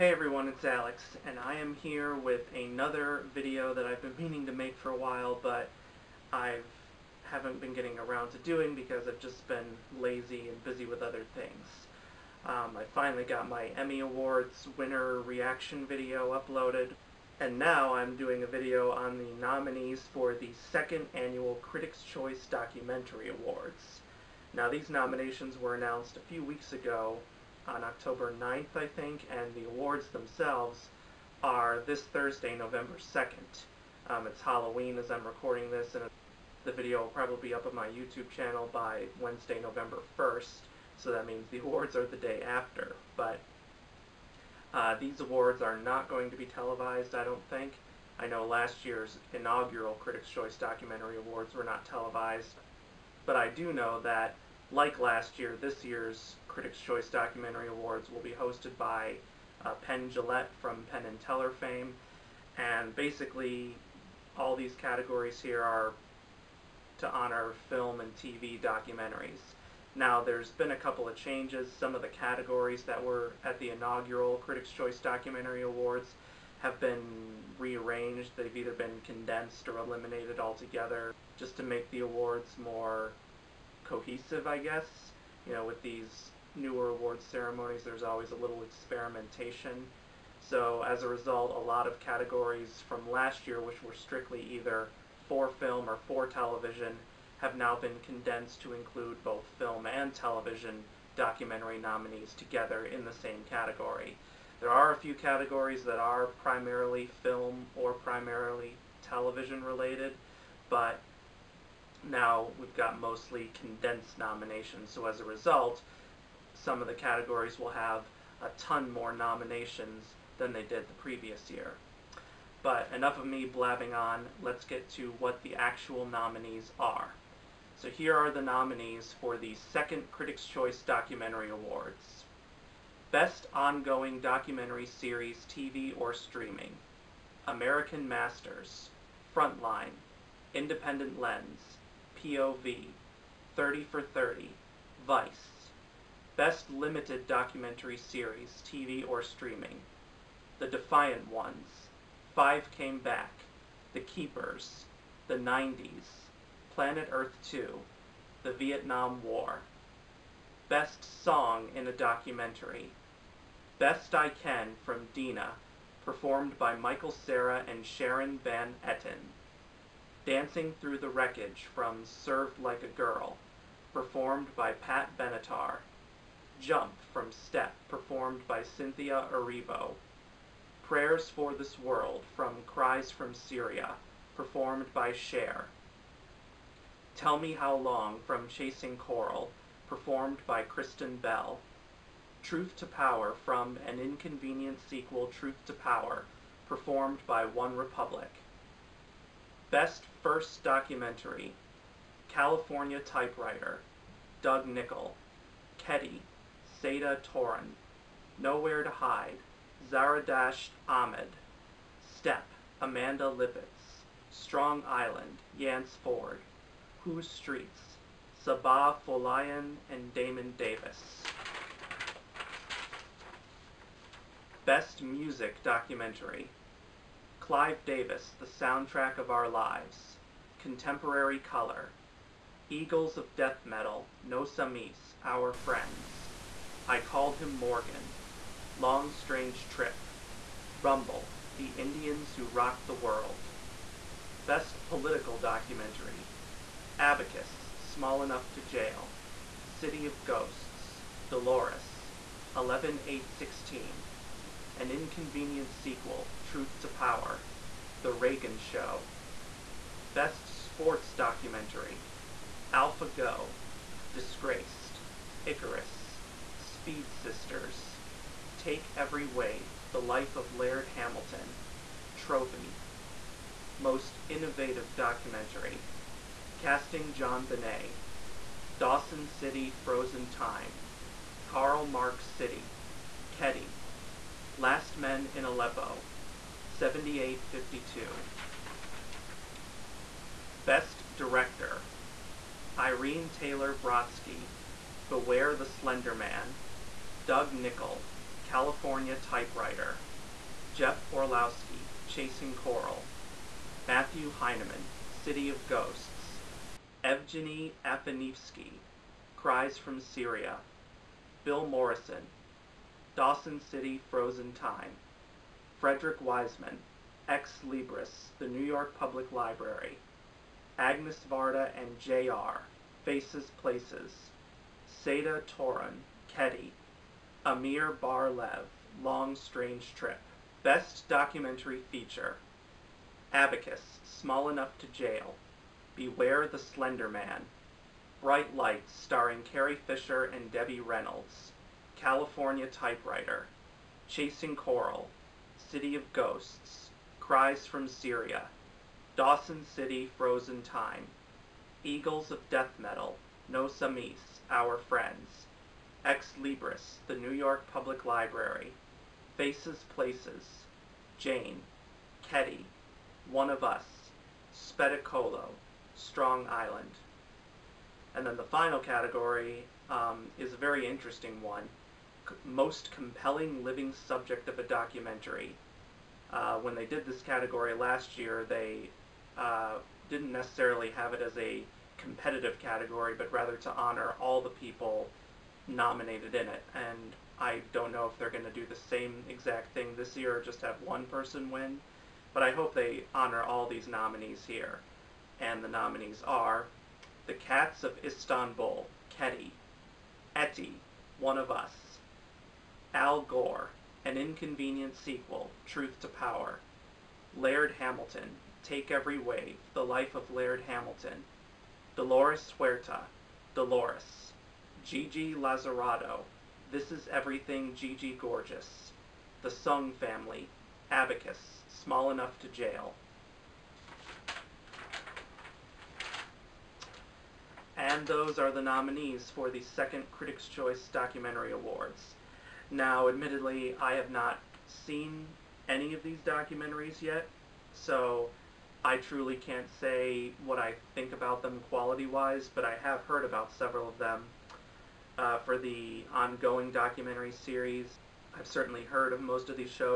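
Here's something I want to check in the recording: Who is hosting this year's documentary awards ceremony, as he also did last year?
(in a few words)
Penn Jillette.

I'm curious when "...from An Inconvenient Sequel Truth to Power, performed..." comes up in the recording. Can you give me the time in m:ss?
3:13.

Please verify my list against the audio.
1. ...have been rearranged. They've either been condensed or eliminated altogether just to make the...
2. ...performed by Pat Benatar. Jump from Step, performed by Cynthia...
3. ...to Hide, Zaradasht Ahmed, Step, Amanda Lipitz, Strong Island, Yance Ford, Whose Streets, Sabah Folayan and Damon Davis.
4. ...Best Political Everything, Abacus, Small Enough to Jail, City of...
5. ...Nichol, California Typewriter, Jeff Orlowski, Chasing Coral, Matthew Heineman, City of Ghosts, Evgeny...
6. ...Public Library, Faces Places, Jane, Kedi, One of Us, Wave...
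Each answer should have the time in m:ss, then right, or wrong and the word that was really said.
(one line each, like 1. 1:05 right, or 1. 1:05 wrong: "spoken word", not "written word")
1. 1:16 right
2. 2:53 right
3. 3:28 right
4. 4:04 wrong: "Documentary", not "Everything"
5. 4:57 right
6. 5:57 wrong: "Spettacolo", not "Wave".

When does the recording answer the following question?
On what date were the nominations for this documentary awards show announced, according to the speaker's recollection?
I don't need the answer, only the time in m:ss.
0:27.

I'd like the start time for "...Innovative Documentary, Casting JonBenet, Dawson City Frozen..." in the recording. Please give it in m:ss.
4:34.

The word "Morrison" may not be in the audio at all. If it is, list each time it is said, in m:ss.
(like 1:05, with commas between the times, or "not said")
5:11.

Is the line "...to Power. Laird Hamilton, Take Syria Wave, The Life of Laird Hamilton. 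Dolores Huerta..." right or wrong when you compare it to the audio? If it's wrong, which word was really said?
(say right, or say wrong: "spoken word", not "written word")
wrong: "Every", not "Syria".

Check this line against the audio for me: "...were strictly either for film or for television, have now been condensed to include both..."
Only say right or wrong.
right.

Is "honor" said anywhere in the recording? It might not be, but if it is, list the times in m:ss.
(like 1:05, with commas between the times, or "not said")
1:07, 6:23, 6:33.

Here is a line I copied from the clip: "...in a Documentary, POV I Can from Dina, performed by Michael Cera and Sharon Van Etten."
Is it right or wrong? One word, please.
wrong.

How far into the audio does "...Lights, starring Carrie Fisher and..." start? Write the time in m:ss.
5:38.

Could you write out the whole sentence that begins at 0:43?
But uh, these awards are not going to be televised, I don't think.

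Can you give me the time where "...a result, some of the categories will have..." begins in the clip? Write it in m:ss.
1:55.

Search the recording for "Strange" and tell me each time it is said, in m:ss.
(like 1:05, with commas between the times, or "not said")
3:59, 5:29.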